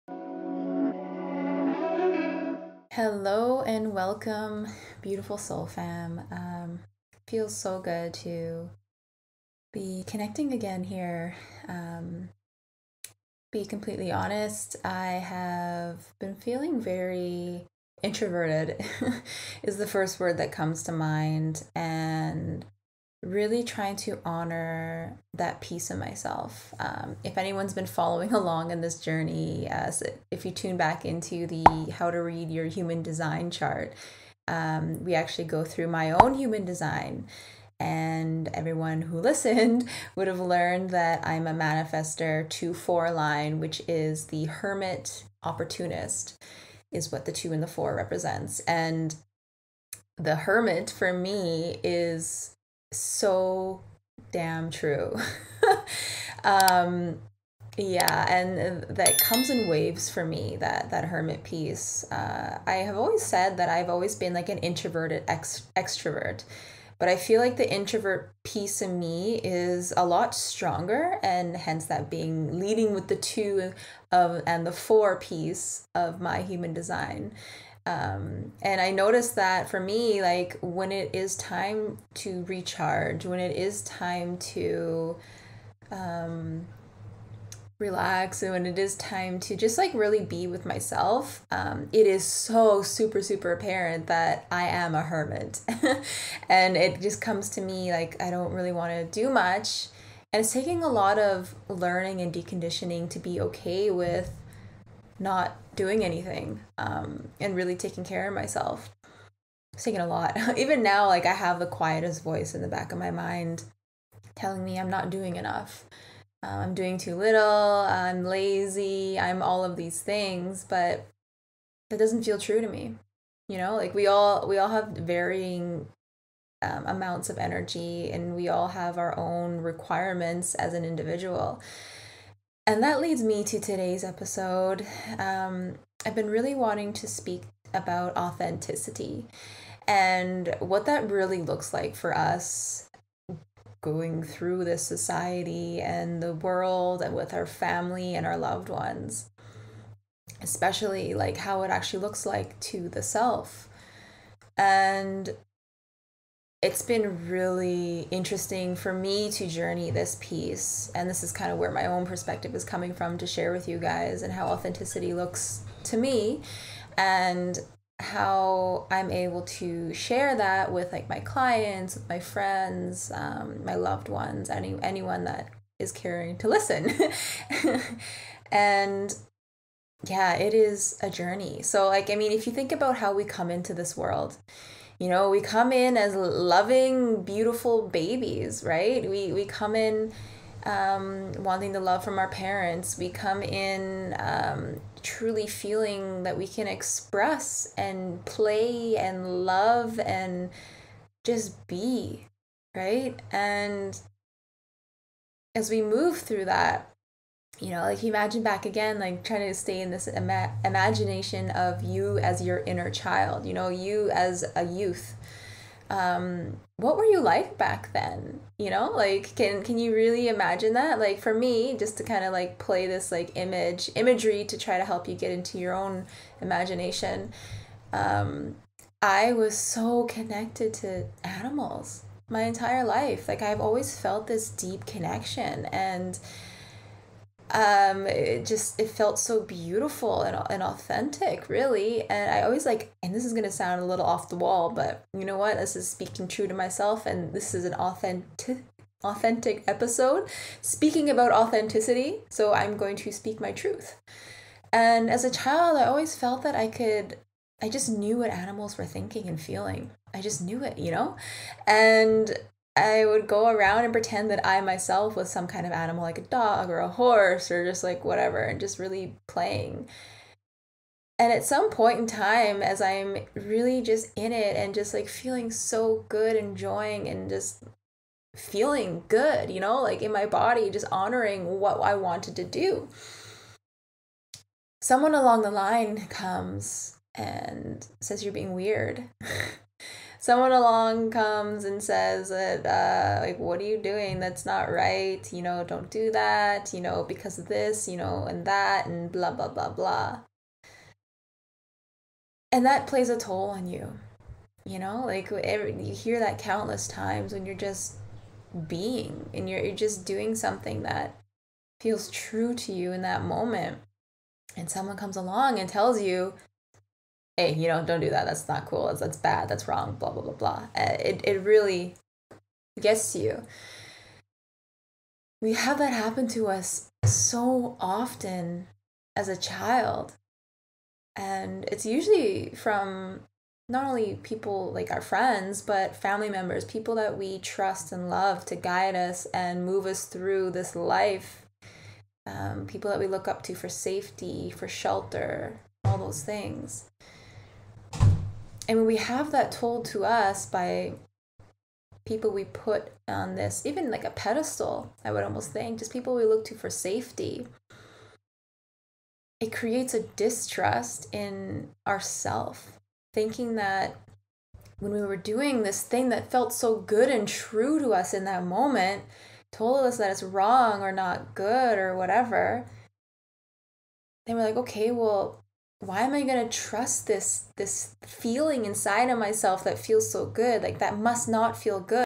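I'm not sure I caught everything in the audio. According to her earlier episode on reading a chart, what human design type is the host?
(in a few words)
Manifestor.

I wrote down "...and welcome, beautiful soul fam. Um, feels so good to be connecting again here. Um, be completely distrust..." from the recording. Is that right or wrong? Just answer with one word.
wrong.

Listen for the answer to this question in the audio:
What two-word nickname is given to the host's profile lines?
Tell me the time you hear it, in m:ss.
0:44.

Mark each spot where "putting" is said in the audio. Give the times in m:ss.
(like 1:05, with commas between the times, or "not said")
not said.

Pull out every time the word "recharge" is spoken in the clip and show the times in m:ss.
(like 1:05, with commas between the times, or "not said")
1:22.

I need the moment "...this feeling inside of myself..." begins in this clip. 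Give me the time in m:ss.
6:17.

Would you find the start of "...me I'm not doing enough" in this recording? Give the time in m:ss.
1:54.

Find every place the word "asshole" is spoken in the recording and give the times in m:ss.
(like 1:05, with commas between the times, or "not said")
not said.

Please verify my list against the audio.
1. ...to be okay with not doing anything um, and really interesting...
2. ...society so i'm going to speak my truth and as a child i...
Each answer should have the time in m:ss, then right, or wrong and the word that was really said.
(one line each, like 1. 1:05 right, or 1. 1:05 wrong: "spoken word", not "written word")
1. 1:43 wrong: "taking", not "interesting"
2. 4:11 wrong: "authenticity", not "society".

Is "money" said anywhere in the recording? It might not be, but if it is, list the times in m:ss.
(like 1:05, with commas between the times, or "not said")
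not said.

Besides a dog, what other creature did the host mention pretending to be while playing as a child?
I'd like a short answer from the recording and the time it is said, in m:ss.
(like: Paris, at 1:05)
a horse, at 4:26.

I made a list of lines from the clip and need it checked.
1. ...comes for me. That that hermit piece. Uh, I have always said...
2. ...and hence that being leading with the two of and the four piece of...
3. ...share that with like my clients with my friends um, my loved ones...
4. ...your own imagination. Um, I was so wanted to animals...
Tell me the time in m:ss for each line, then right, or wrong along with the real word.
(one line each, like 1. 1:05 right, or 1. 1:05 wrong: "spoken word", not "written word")
1. 0:59 wrong: "waves", not "comes"
2. 1:11 right
3. 2:49 right
4. 3:45 wrong: "connected", not "wanted".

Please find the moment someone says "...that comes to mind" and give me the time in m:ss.
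0:20.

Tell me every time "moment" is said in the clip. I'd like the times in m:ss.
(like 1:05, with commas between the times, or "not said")
5:13, 6:08.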